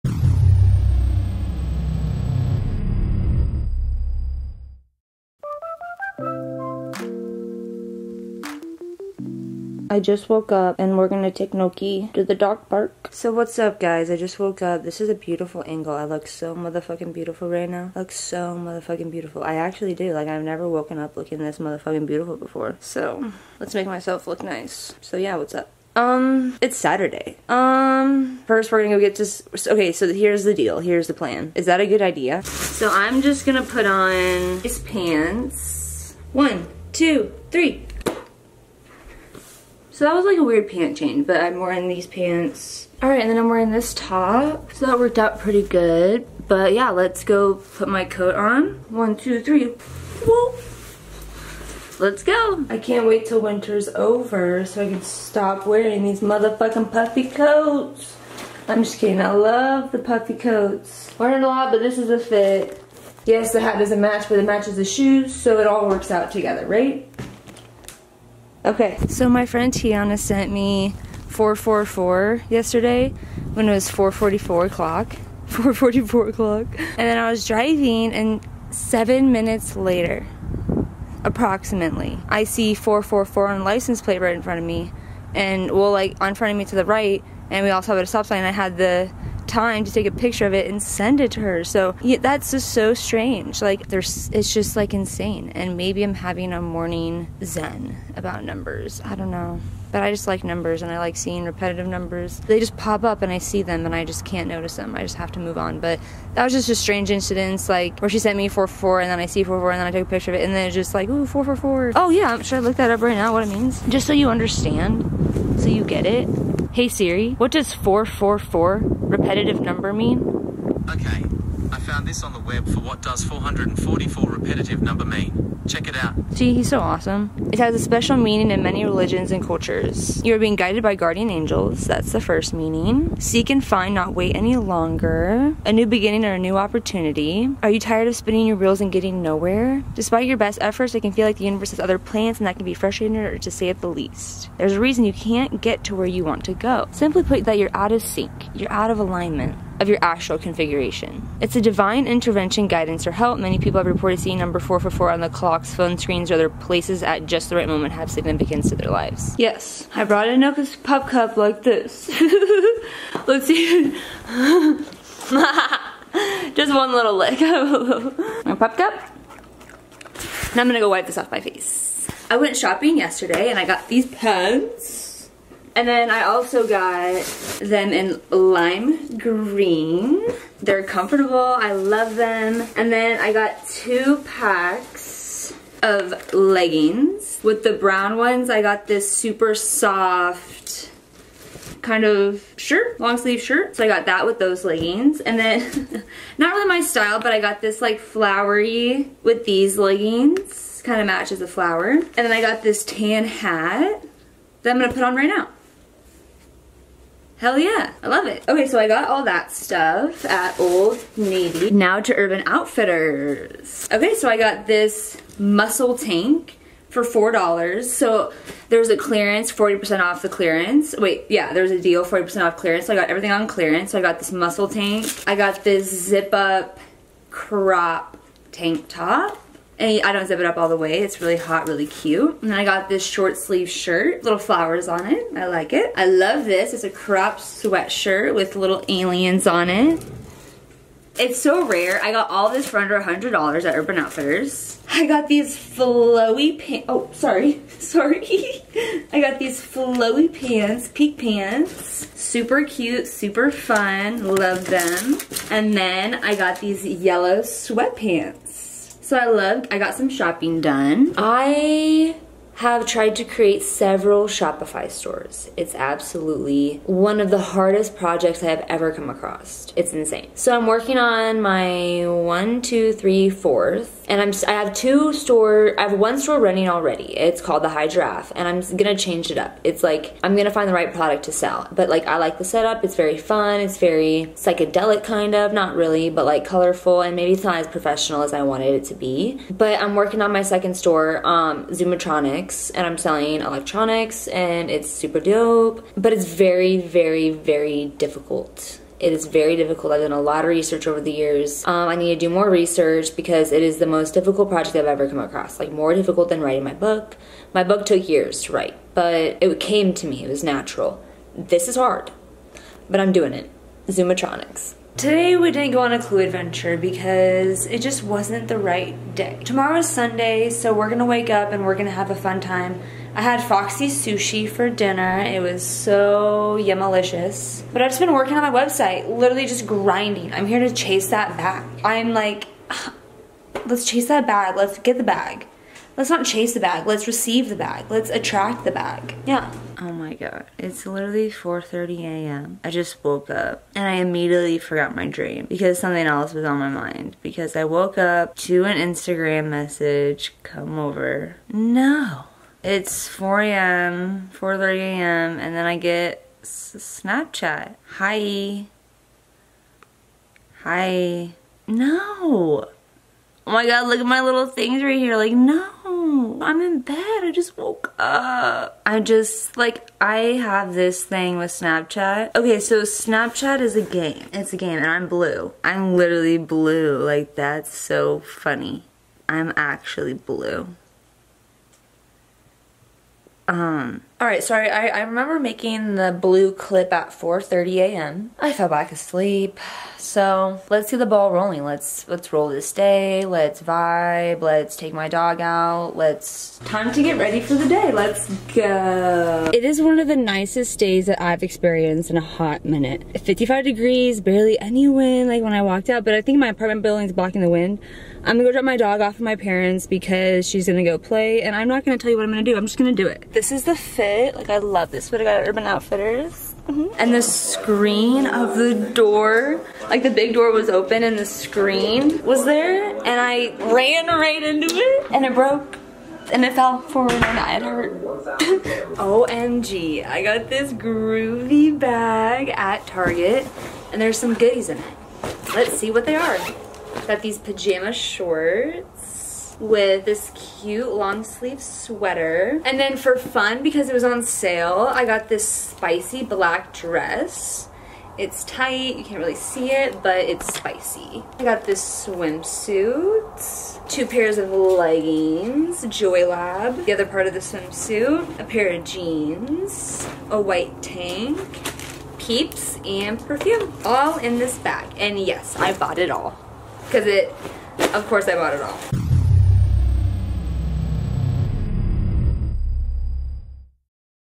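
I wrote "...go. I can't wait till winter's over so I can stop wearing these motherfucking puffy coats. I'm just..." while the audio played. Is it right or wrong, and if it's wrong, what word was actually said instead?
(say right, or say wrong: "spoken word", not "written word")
right.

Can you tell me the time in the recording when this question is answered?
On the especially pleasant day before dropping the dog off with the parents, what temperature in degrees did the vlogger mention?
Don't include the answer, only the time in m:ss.
6:43.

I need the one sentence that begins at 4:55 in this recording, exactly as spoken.
But it's very, very, very difficult it is very difficult.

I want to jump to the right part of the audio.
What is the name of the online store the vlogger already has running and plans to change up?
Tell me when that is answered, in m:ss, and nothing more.
4:37.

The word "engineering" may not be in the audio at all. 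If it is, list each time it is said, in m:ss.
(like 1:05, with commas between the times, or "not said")
not said.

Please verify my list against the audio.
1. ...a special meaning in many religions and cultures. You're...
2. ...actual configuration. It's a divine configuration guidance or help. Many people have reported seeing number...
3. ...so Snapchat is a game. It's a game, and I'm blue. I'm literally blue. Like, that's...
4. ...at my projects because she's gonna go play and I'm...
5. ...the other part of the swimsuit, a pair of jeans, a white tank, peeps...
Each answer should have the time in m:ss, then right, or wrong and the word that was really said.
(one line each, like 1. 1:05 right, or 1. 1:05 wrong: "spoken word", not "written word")
1. 2:07 right
2. 2:30 wrong: "intervention", not "configuration"
3. 6:12 right
4. 6:49 wrong: "parents", not "projects"
5. 7:36 right.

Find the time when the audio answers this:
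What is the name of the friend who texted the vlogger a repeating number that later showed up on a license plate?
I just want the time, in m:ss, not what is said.
1:09.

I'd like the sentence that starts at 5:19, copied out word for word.
Tomorrow's Sunday, so we're gonna wake up and we're gonna have a fun time.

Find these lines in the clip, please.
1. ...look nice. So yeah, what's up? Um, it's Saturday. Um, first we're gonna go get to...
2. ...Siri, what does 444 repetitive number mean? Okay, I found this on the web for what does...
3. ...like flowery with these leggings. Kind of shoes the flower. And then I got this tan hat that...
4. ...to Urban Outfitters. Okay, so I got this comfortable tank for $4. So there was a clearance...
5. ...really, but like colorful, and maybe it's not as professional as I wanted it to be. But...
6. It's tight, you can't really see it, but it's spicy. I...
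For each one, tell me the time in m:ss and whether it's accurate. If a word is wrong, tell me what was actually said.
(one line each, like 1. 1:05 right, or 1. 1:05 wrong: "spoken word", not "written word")
1. 0:24 right
2. 1:56 right
3. 3:17 wrong: "matches", not "shoes"
4. 3:31 wrong: "muscle", not "comfortable"
5. 4:45 right
6. 7:28 right.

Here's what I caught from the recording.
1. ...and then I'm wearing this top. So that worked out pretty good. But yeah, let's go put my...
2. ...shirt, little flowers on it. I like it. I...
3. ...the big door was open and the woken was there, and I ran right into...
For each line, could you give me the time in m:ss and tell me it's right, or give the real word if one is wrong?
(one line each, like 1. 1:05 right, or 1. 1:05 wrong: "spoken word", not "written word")
1. 0:43 right
2. 3:53 right
3. 7:00 wrong: "screen", not "woken".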